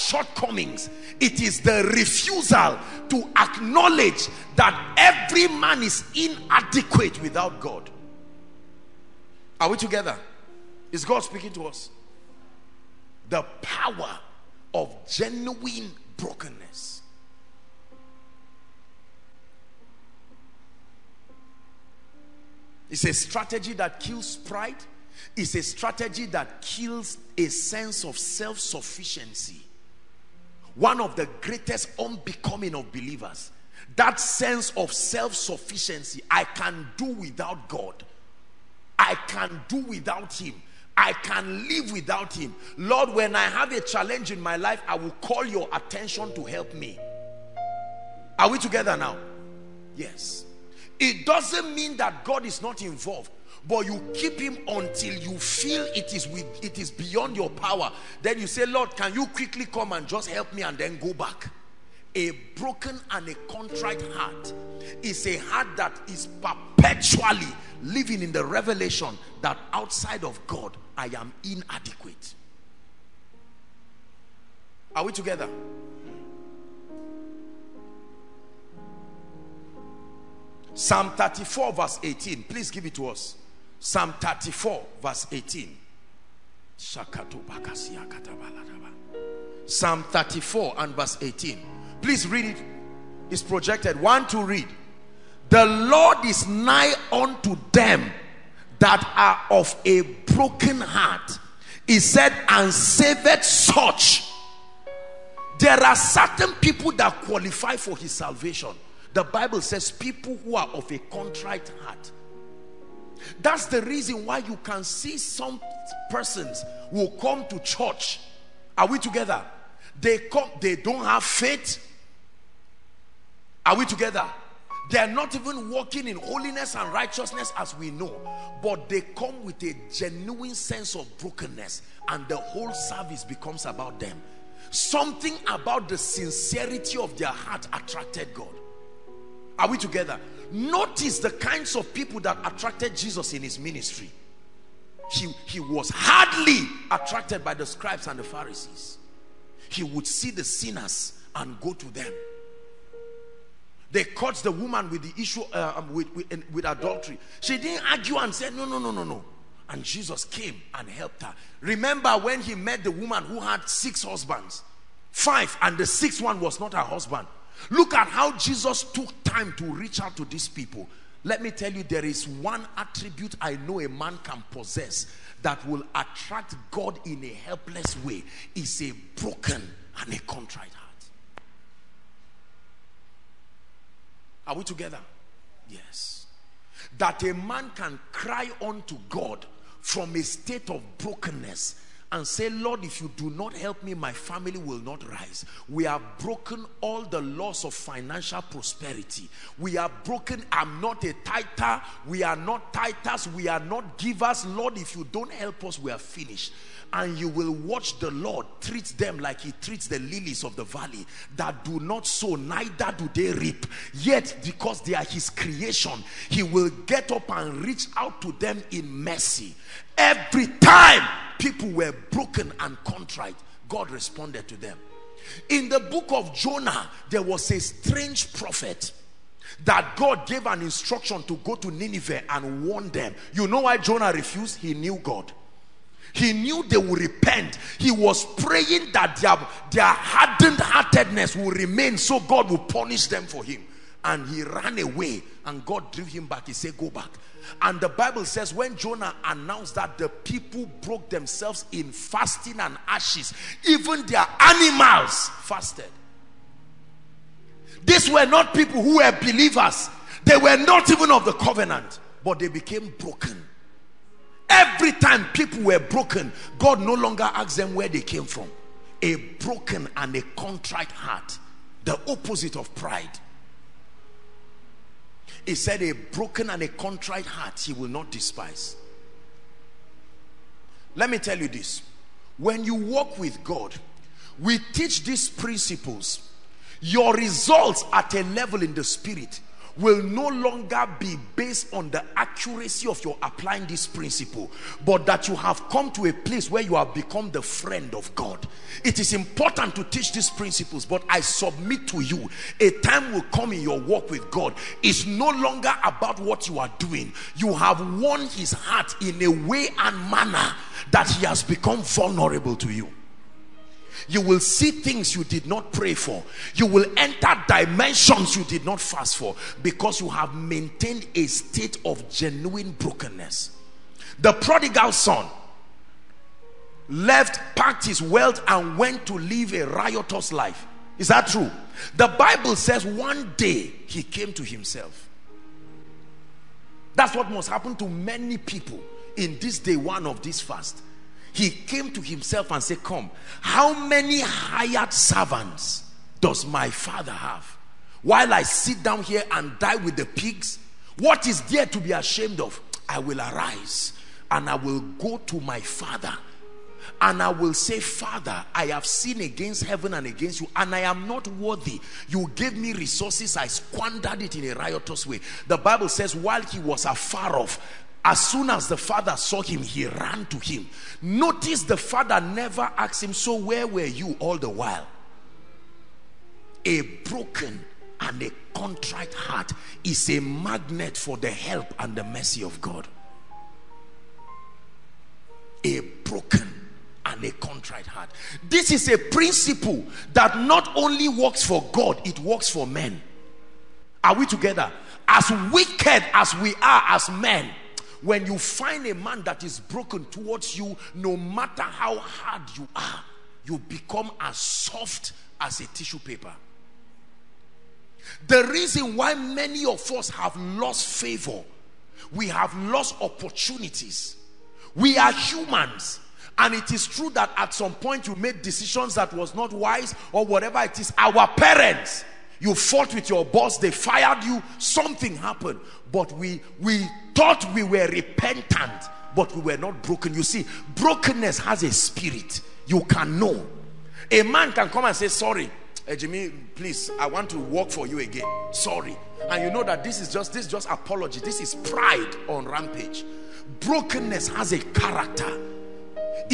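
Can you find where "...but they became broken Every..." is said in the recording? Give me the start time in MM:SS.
04:22.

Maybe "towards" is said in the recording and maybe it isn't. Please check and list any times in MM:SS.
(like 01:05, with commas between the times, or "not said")
06:40.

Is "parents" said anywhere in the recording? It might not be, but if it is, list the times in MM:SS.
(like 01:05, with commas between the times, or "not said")
07:01.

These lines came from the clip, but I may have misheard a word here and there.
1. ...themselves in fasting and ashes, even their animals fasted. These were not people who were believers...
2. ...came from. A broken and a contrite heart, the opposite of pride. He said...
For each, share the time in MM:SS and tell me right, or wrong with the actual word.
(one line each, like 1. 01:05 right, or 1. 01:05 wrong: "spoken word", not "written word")
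1. 04:11 right
2. 04:28 right.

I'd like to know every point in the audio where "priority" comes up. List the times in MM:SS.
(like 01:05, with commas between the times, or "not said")
not said.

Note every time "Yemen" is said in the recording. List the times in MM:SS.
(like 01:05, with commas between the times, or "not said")
not said.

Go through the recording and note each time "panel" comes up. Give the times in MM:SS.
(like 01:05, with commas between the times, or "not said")
not said.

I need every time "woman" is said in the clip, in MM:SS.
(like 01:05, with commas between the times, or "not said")
02:34, 02:42.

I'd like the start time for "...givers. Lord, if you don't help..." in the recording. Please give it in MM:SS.
03:23.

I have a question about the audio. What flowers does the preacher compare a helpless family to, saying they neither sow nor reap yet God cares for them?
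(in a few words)
Lilies of the valley.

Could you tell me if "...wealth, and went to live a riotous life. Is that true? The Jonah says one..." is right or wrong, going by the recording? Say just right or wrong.
wrong.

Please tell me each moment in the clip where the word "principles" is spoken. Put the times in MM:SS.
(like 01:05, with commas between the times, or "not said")
04:45, 04:53, 05:00, 06:28.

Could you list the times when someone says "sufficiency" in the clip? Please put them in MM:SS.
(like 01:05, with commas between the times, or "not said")
00:28, 00:34.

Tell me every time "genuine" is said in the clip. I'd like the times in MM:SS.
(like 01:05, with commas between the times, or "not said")
00:15, 02:09, 05:22.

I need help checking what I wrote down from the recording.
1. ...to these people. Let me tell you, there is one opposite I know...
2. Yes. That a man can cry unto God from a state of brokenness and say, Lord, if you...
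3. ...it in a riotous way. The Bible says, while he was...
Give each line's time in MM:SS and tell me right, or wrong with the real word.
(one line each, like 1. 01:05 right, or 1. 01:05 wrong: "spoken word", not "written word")
1. 02:50 wrong: "attribute", not "opposite"
2. 03:05 right
3. 06:04 right.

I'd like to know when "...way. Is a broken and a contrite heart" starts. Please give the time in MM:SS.
02:58.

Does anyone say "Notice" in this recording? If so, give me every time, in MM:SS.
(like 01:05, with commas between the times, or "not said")
02:20, 06:11.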